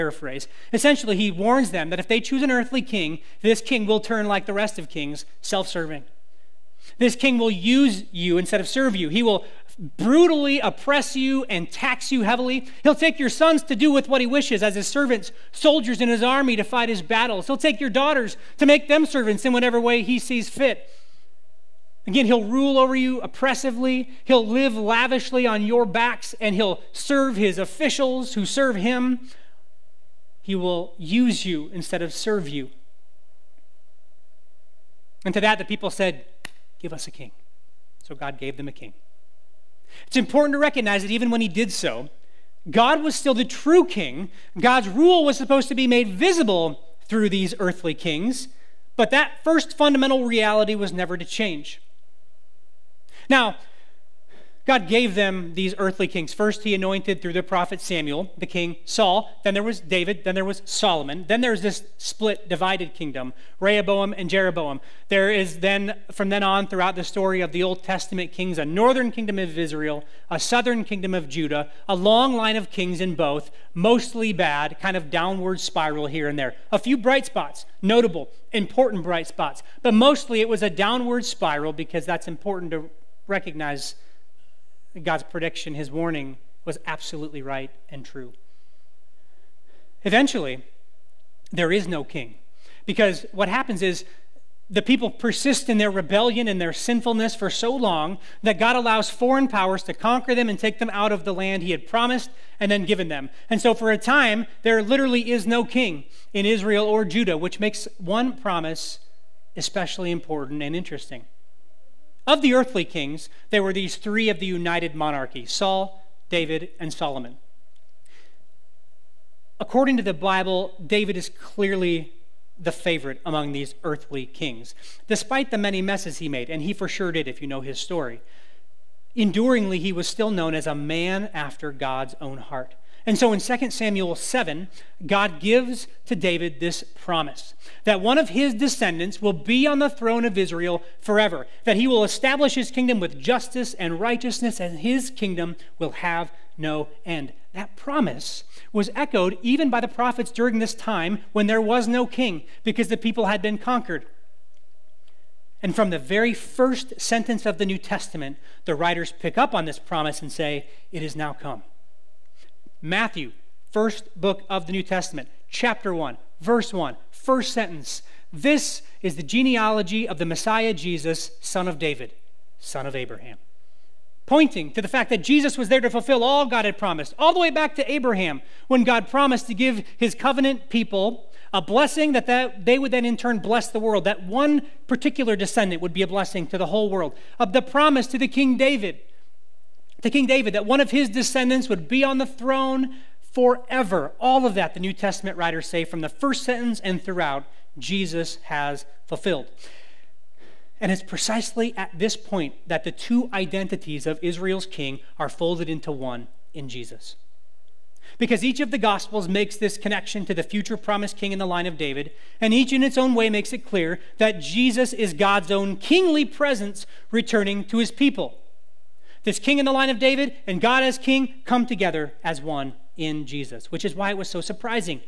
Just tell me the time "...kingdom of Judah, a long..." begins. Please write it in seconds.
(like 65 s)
70 s.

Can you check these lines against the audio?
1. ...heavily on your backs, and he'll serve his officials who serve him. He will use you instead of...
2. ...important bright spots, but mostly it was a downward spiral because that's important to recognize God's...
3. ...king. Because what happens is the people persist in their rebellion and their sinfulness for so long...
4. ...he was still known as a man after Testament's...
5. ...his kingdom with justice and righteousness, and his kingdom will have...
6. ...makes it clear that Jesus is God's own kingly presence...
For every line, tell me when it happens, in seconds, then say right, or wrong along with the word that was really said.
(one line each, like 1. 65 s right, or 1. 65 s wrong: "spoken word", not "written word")
1. 24 s wrong: "lavishly", not "heavily"
2. 78 s right
3. 92 s right
4. 129 s wrong: "God", not "Testament"
5. 142 s right
6. 213 s right.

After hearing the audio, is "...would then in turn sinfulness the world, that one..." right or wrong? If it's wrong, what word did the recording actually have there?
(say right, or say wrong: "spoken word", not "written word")
wrong: "bless", not "sinfulness".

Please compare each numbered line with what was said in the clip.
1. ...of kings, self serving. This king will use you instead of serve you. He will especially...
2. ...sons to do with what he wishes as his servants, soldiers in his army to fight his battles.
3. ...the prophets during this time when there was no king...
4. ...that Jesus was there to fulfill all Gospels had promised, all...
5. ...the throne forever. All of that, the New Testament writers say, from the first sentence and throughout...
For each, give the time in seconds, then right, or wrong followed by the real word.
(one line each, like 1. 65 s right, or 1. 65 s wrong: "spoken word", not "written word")
1. 4 s wrong: "brutally", not "especially"
2. 13 s right
3. 149 s right
4. 175 s wrong: "God", not "Gospels"
5. 192 s right.